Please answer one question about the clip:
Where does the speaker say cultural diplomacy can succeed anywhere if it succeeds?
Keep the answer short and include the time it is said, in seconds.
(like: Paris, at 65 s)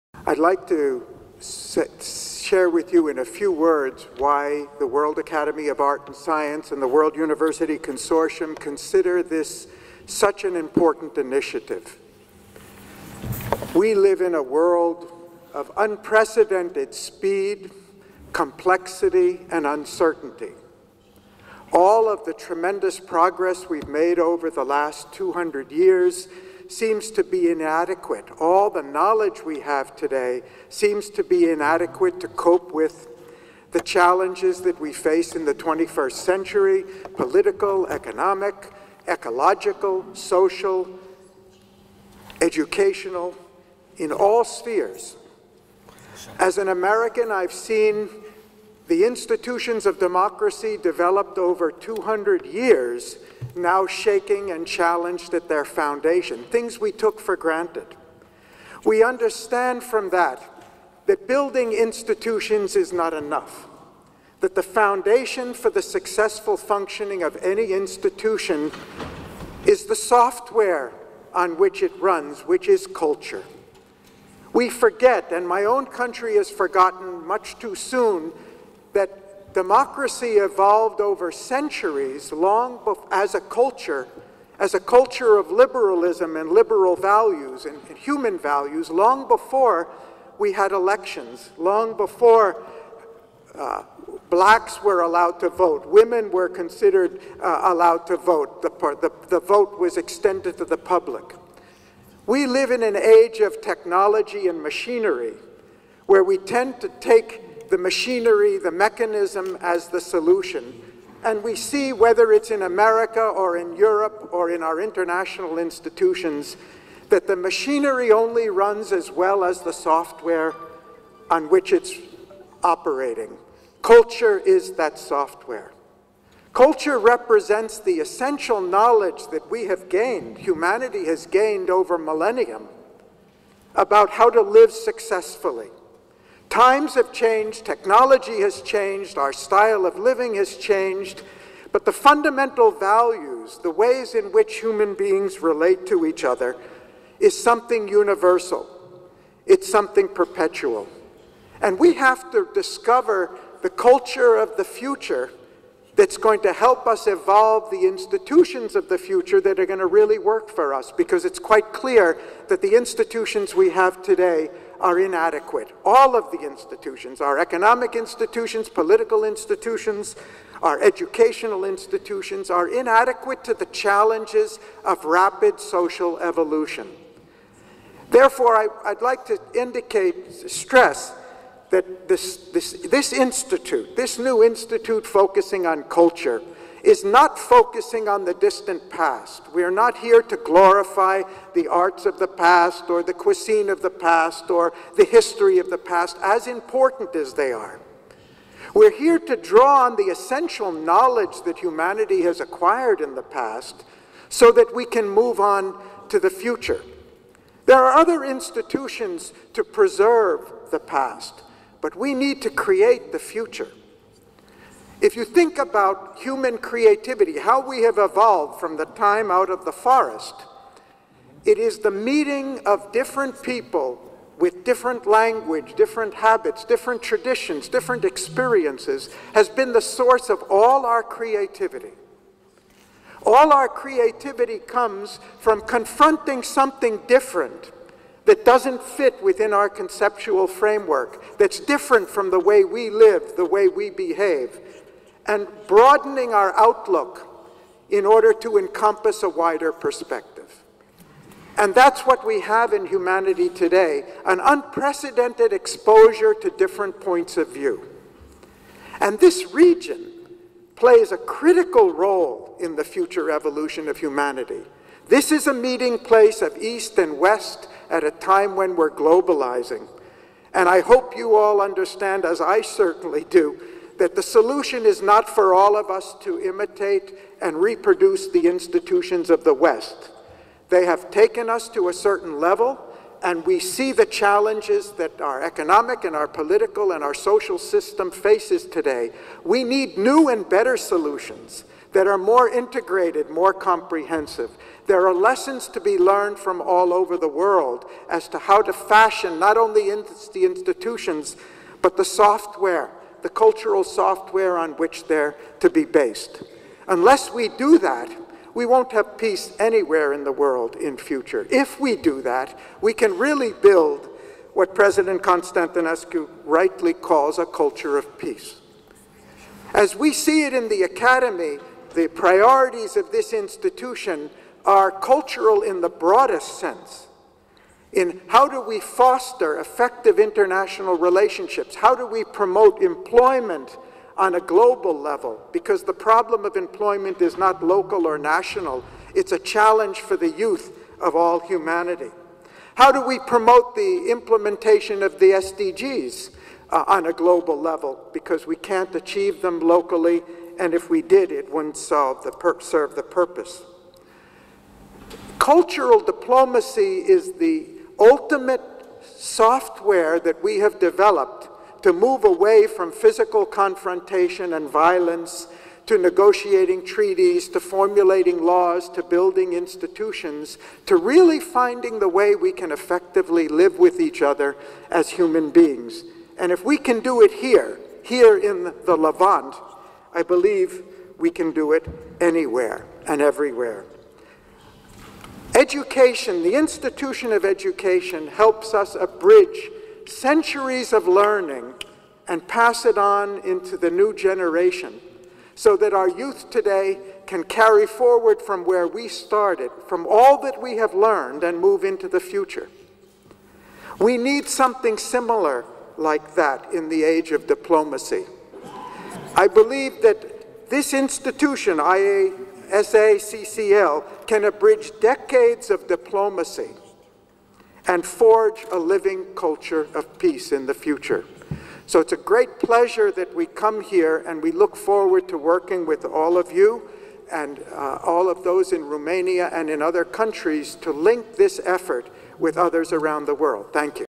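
the Levant, at 378 s.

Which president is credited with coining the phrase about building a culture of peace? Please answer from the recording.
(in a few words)
President Constantinescu.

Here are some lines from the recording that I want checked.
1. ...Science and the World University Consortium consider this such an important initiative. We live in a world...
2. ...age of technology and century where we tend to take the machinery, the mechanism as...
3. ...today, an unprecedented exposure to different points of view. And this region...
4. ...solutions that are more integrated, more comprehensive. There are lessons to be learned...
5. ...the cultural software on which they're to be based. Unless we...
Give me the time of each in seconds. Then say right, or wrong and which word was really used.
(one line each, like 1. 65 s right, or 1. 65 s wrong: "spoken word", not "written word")
1. 6 s right
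2. 102 s wrong: "machinery", not "century"
3. 253 s right
4. 290 s right
5. 303 s right.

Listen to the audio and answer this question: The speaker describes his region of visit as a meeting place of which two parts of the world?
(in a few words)
East and West.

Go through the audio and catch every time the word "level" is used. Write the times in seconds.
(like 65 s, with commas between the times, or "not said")
282 s, 334 s, 347 s.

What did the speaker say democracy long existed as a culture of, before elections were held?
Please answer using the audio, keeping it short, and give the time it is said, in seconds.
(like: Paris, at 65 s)
liberalism, at 85 s.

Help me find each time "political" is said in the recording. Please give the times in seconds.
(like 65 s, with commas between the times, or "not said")
37 s, 168 s, 286 s.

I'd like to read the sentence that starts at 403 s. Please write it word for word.
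We need something similar like that in the age of diplomacy.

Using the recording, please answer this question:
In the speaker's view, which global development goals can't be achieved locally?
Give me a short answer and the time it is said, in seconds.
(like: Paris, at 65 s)
SDGs, at 345 s.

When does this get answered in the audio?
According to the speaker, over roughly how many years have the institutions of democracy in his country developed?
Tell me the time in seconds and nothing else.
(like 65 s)
51 s.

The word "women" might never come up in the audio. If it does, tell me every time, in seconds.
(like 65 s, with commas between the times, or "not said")
95 s.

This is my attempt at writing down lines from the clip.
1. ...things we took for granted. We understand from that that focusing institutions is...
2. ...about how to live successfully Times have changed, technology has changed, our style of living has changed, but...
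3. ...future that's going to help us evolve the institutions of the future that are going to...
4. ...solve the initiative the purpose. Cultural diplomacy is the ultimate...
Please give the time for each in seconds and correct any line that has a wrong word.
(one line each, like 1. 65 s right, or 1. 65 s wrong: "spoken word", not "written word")
1. 56 s wrong: "building", not "focusing"
2. 133 s right
3. 154 s right
4. 351 s wrong: "serve", not "initiative".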